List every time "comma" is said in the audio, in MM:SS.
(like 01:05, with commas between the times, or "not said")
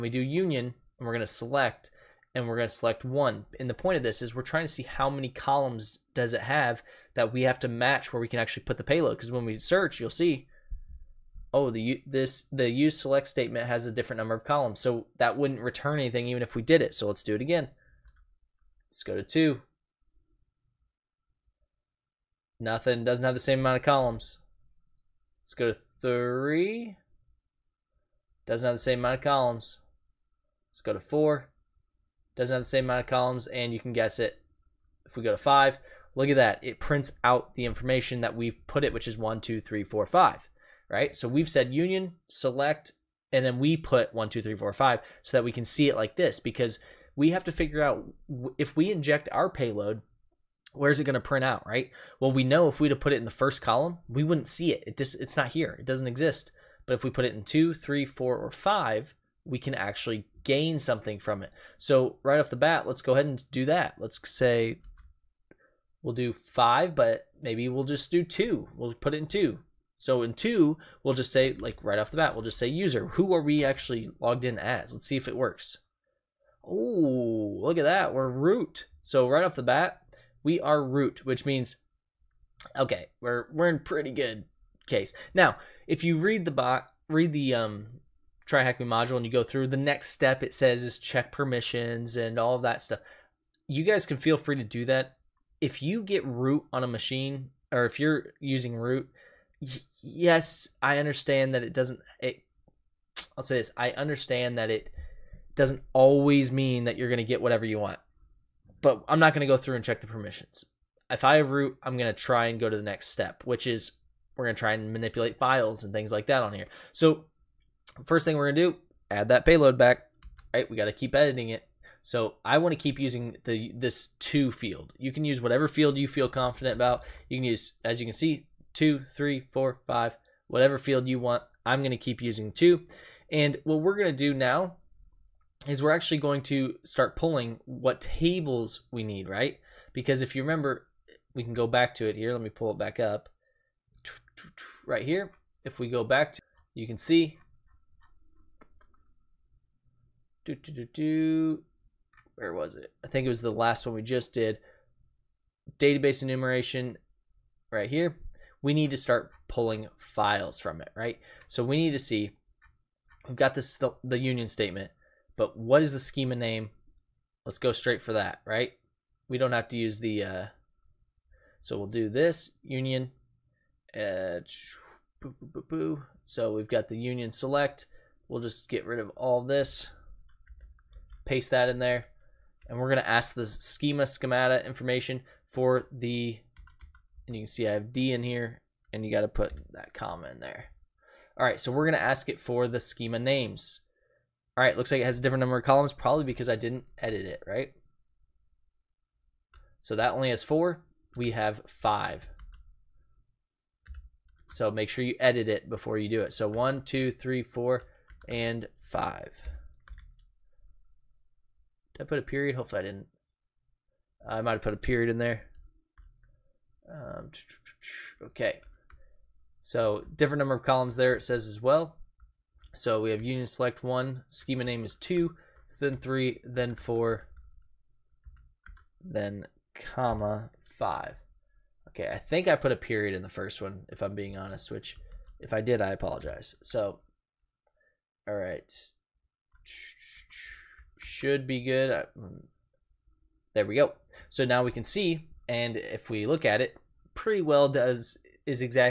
03:09, 03:49.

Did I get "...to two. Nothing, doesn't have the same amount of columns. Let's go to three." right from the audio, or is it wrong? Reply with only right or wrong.
right.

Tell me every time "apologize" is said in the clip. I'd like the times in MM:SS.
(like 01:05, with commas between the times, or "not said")
03:55.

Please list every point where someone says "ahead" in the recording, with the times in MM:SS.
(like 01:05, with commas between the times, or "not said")
01:03.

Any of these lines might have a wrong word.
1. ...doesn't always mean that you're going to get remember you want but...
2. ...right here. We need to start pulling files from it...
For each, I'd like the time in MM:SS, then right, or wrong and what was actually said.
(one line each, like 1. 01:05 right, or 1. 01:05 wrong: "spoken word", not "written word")
1. 01:45 wrong: "whatever", not "remember"
2. 02:37 right.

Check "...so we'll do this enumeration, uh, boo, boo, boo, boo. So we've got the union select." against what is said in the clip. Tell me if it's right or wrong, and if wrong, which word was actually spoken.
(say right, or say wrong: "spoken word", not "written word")
wrong: "union", not "enumeration".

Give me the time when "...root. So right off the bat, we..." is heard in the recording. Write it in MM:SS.
01:18.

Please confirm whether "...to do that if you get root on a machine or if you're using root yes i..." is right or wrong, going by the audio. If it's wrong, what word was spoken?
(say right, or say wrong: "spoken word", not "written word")
right.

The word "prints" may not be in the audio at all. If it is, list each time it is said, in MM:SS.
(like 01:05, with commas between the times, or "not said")
00:36, 00:51.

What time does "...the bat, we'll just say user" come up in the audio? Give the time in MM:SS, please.
01:12.